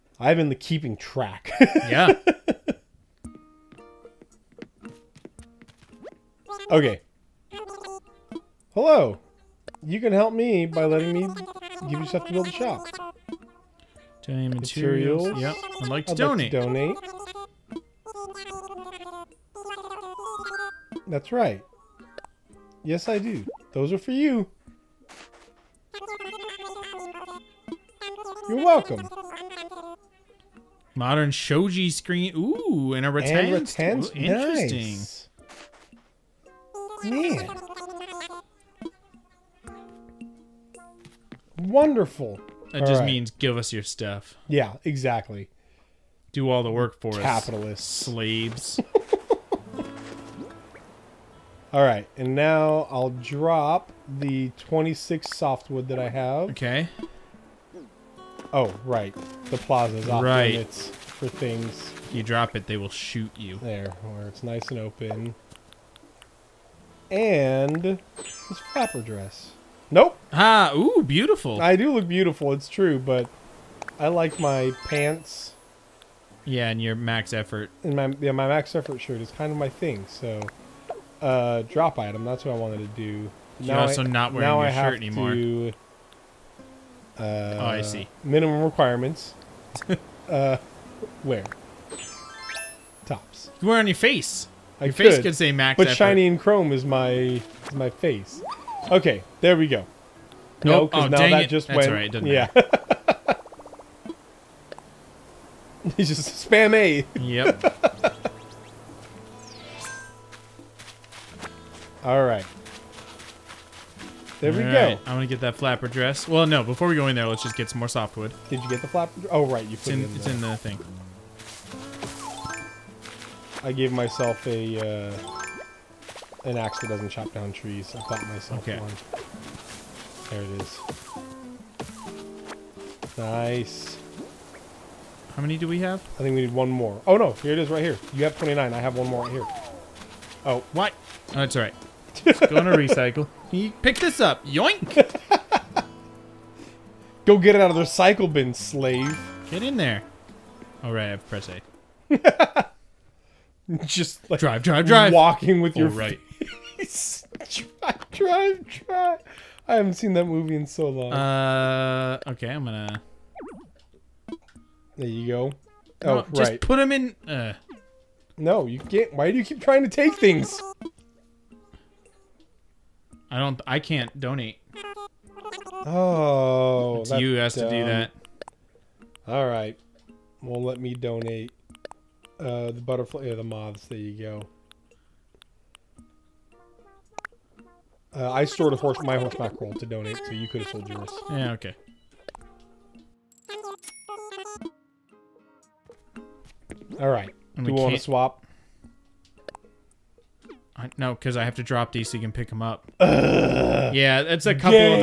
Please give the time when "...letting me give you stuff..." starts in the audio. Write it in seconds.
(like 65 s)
10 s.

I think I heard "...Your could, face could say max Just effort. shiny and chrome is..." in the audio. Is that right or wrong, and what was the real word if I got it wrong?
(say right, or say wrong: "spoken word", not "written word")
wrong: "But", not "Just".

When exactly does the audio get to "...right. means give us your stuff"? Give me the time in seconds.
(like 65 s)
43 s.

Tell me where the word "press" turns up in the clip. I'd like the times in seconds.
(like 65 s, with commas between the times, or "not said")
151 s.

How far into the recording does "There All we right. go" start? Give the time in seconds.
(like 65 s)
114 s.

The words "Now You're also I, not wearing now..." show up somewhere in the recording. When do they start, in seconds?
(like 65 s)
83 s.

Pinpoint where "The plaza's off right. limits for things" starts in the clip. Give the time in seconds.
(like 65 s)
59 s.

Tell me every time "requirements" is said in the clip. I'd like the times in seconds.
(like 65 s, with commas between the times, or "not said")
88 s.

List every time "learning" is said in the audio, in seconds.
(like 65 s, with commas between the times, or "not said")
not said.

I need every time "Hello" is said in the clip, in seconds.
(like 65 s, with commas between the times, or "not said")
8 s.